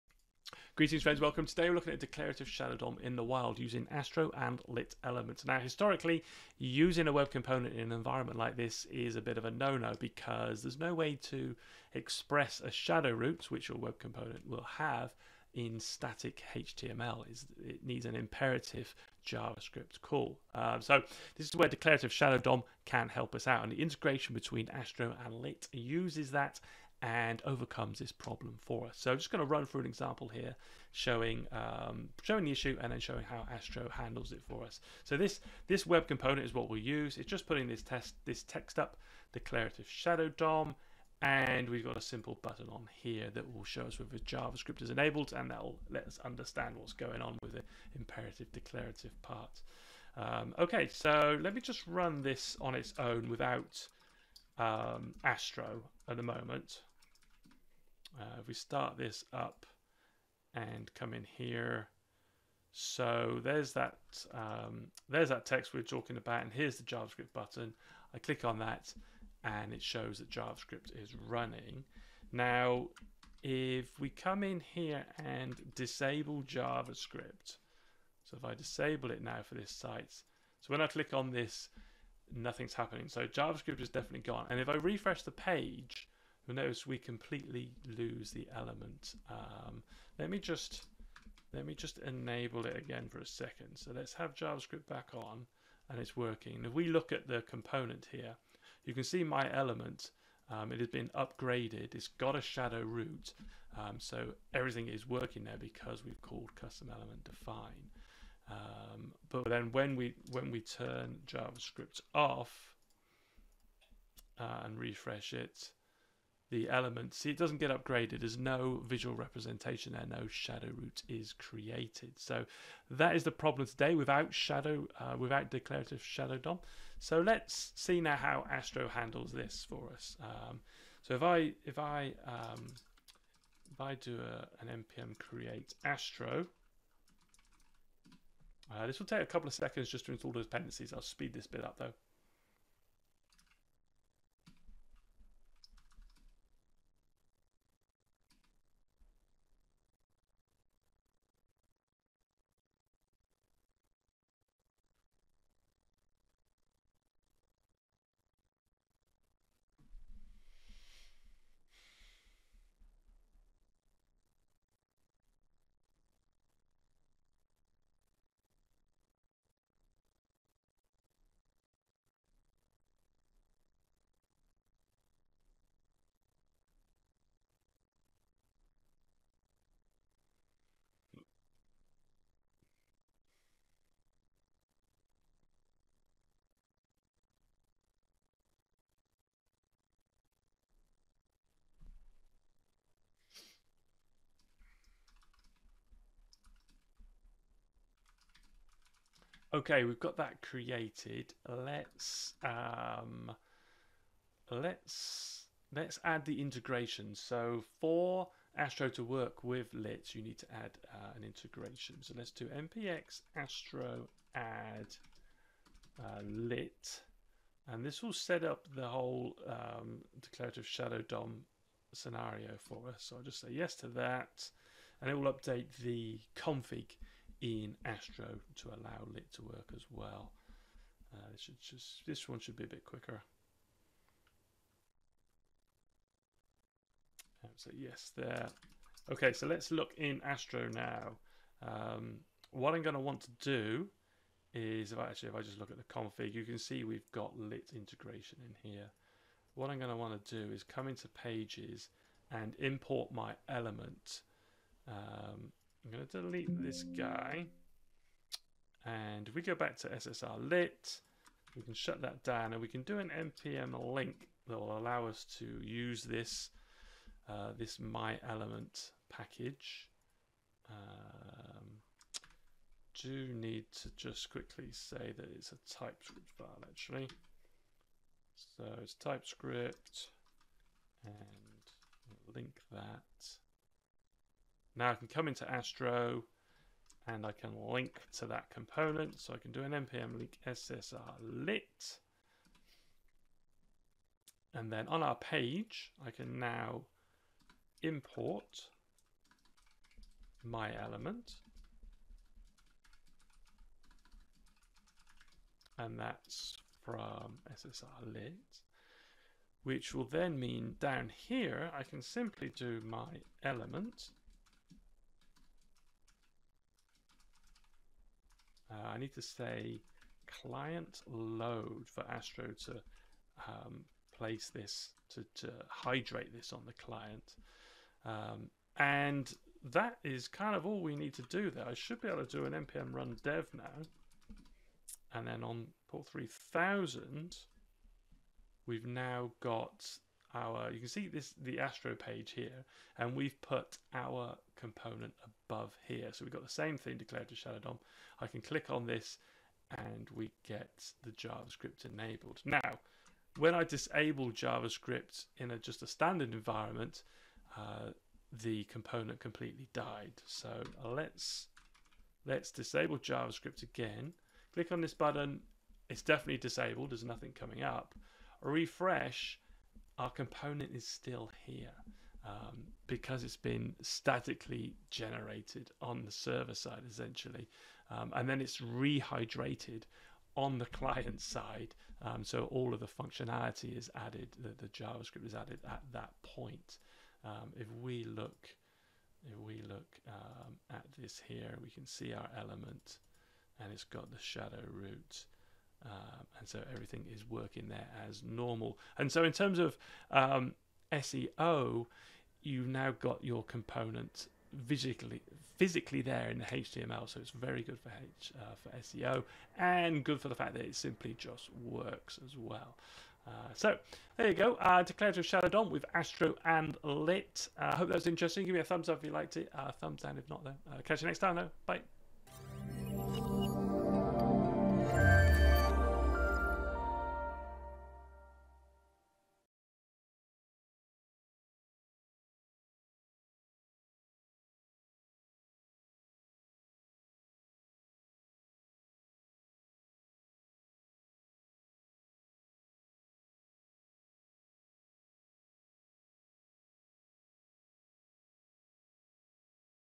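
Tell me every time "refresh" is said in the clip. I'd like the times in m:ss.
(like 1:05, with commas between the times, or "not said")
1:24, 1:54, 6:08.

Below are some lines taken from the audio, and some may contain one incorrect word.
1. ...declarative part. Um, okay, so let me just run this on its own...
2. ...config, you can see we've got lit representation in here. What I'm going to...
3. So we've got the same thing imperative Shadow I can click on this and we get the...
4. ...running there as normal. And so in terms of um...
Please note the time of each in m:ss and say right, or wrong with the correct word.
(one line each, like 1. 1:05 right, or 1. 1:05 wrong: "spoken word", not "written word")
1. 0:48 right
2. 4:05 wrong: "integration", not "representation"
3. 5:46 wrong: "declarative", not "imperative"
4. 6:37 wrong: "working", not "running".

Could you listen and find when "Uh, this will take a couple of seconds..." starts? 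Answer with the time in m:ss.
2:18.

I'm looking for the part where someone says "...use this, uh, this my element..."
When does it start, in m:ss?
4:25.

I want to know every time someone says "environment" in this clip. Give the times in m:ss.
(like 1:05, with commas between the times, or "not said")
0:07, 5:56.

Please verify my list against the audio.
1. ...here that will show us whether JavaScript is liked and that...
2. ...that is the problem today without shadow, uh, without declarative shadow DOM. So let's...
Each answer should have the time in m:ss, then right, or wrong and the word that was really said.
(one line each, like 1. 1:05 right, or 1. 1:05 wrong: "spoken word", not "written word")
1. 0:43 wrong: "enabled", not "liked"
2. 2:02 right.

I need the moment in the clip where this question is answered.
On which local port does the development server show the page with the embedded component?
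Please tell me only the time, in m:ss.
5:35.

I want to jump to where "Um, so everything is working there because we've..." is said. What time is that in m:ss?
1:43.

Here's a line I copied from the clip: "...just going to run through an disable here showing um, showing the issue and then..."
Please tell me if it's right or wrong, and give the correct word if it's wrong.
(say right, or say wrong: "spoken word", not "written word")
wrong: "example", not "disable".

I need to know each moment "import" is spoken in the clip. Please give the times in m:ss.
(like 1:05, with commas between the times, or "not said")
4:12, 4:57.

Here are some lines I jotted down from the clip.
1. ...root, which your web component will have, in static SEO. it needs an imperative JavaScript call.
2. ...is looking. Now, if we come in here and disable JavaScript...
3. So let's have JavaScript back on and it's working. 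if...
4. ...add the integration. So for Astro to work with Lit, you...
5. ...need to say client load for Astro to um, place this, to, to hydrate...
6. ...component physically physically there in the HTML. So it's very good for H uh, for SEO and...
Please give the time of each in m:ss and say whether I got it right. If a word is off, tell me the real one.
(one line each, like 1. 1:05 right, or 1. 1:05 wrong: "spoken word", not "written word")
1. 0:13 wrong: "HTML", not "SEO"
2. 1:11 wrong: "running", not "looking"
3. 1:33 right
4. 3:26 right
5. 5:18 right
6. 6:43 right.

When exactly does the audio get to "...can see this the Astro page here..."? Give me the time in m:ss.
5:40.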